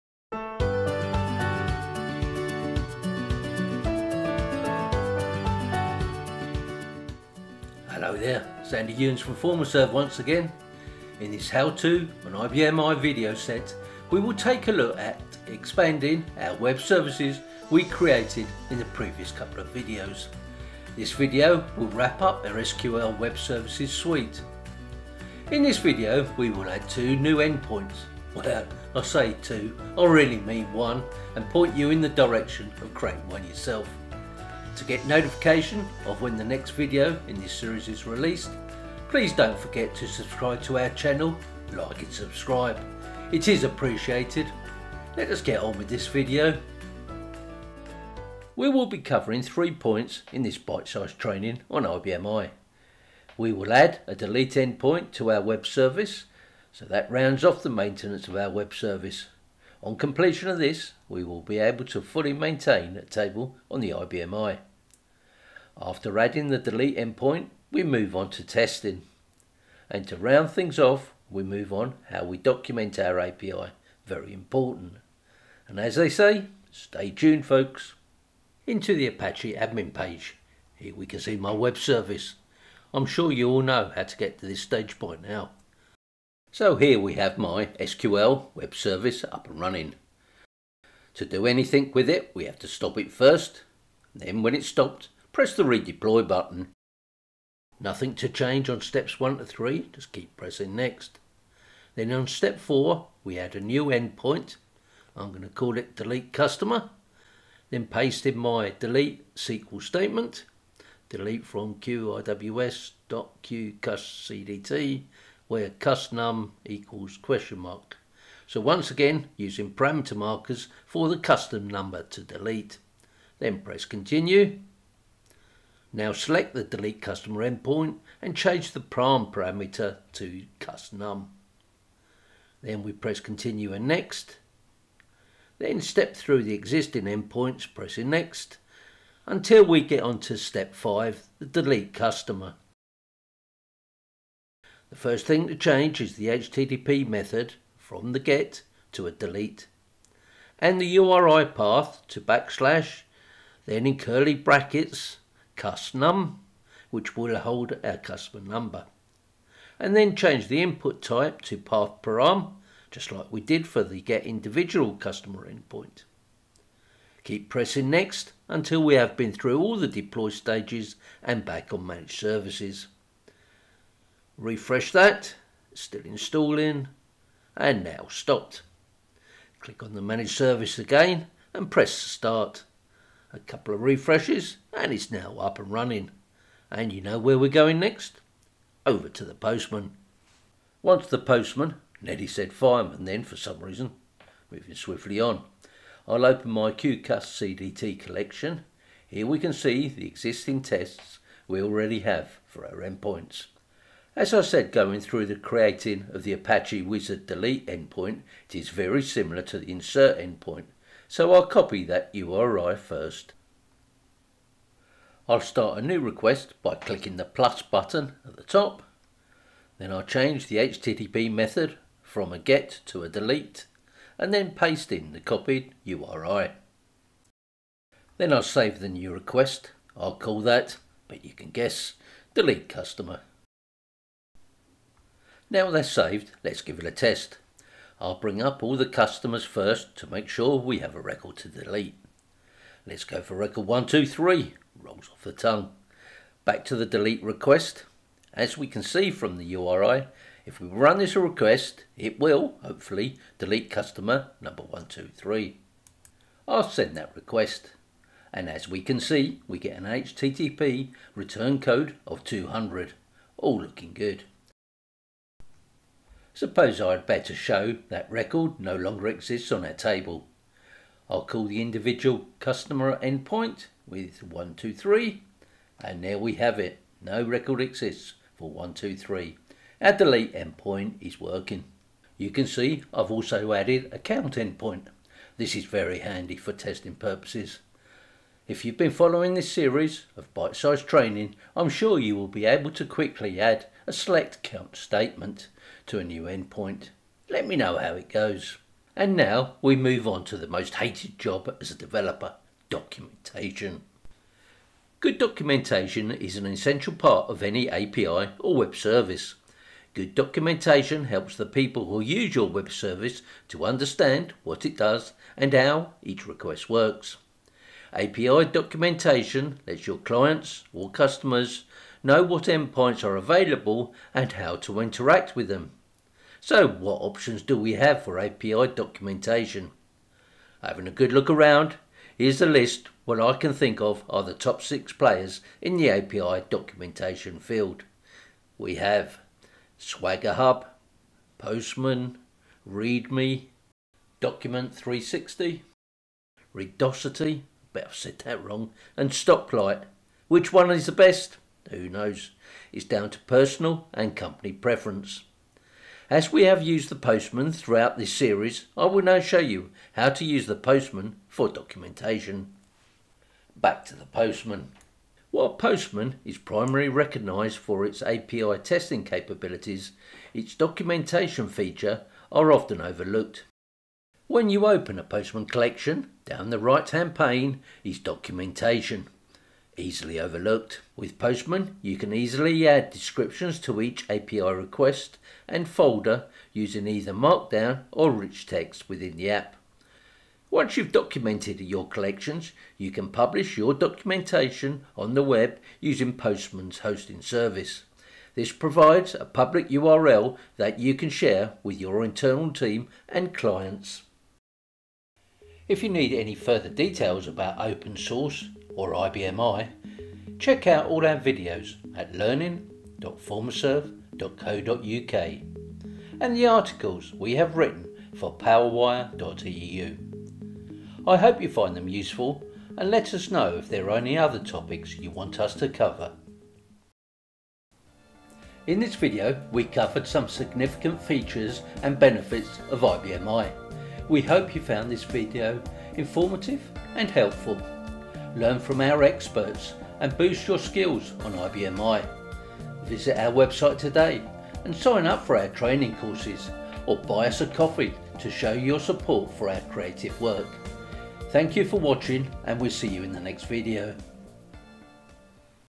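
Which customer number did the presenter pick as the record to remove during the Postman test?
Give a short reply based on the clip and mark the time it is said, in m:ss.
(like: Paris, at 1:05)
123, at 4:03.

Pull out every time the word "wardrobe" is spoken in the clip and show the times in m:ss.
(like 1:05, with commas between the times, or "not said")
not said.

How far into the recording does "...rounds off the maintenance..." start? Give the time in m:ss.
0:57.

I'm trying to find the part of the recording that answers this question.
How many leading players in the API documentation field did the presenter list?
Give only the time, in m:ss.
5:34.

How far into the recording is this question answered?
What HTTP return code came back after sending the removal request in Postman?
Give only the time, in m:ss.
4:22.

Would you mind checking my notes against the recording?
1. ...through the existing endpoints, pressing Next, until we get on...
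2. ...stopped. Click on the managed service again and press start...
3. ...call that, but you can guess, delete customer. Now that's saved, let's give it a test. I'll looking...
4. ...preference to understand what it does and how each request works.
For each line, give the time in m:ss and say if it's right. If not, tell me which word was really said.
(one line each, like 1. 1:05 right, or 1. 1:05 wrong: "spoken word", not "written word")
1. 2:16 right
2. 2:58 right
3. 3:50 wrong: "bring", not "looking"
4. 5:12 wrong: "service", not "preference".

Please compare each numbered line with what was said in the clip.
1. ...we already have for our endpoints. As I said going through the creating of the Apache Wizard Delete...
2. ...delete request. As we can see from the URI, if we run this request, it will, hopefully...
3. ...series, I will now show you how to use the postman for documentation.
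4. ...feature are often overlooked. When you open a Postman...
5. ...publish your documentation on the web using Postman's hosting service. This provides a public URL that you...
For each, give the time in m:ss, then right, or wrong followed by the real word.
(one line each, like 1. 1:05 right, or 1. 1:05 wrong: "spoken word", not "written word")
1. 3:21 right
2. 4:06 right
3. 5:58 right
4. 6:11 right
5. 6:33 right.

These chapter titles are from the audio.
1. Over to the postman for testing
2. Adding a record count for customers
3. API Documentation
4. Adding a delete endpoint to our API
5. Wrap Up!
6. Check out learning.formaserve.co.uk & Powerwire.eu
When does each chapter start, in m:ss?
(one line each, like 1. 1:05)
1. 3:10
2. 4:43
3. 5:03
4. 1:19
5. 7:07
6. 6:45.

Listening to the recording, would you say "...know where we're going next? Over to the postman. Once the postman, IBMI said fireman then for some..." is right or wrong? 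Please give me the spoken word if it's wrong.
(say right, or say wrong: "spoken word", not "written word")
wrong: "Neddy", not "IBMI".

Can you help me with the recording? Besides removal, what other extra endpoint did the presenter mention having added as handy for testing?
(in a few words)
count endpoint.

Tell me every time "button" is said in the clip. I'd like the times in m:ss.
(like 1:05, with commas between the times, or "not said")
1:36, 3:37.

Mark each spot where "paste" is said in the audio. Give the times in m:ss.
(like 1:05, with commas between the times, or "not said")
1:47, 3:44.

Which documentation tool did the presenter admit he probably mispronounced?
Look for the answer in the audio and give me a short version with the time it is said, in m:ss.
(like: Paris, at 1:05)
Redosity, at 5:46.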